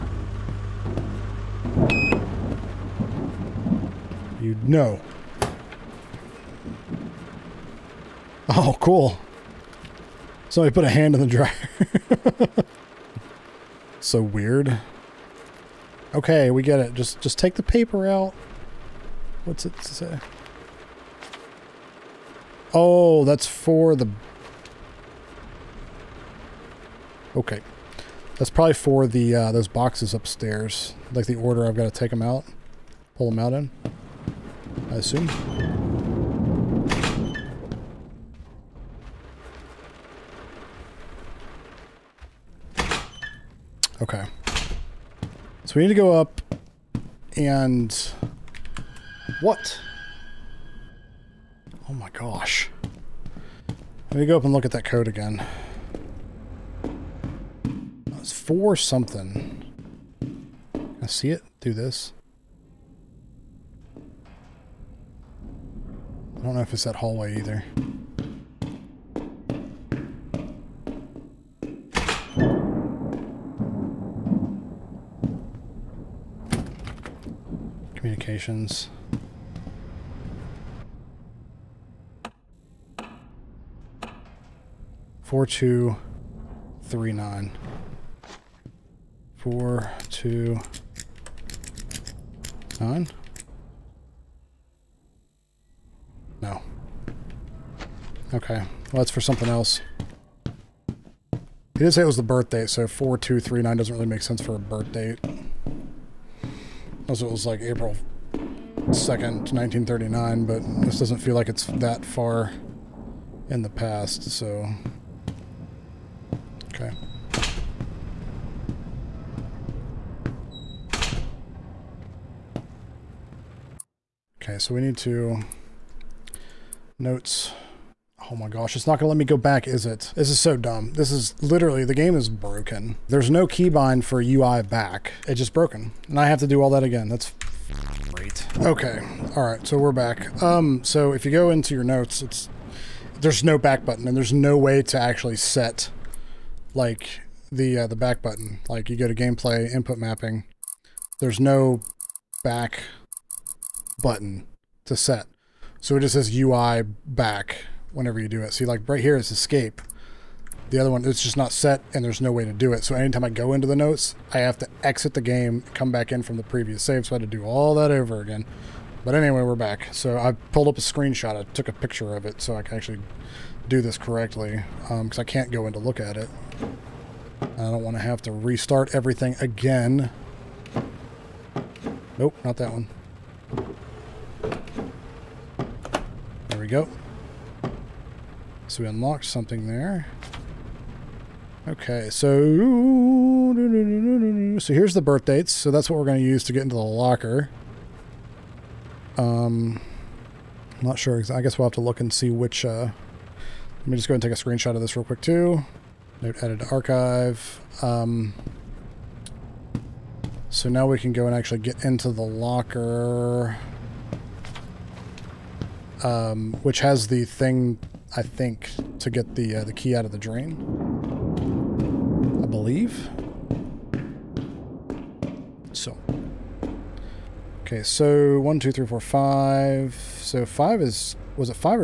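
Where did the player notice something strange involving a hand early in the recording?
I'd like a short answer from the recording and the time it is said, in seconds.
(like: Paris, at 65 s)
the dryer, at 11 s.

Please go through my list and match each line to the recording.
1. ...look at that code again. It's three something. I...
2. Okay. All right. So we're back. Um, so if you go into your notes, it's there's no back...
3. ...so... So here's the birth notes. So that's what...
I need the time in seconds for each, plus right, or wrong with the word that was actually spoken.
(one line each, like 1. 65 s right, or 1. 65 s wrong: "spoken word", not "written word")
1. 54 s wrong: "four", not "three"
2. 138 s right
3. 192 s wrong: "dates", not "notes".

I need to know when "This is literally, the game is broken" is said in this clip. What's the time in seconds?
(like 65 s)
130 s.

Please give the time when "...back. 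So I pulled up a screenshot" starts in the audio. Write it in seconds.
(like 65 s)
169 s.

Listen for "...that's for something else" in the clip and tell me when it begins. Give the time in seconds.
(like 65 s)
98 s.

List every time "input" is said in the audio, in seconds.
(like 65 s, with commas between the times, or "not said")
149 s.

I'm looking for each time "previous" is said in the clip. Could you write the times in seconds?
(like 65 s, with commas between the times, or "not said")
166 s.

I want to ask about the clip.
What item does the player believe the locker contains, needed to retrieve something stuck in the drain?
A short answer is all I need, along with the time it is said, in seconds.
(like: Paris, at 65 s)
key, at 219 s.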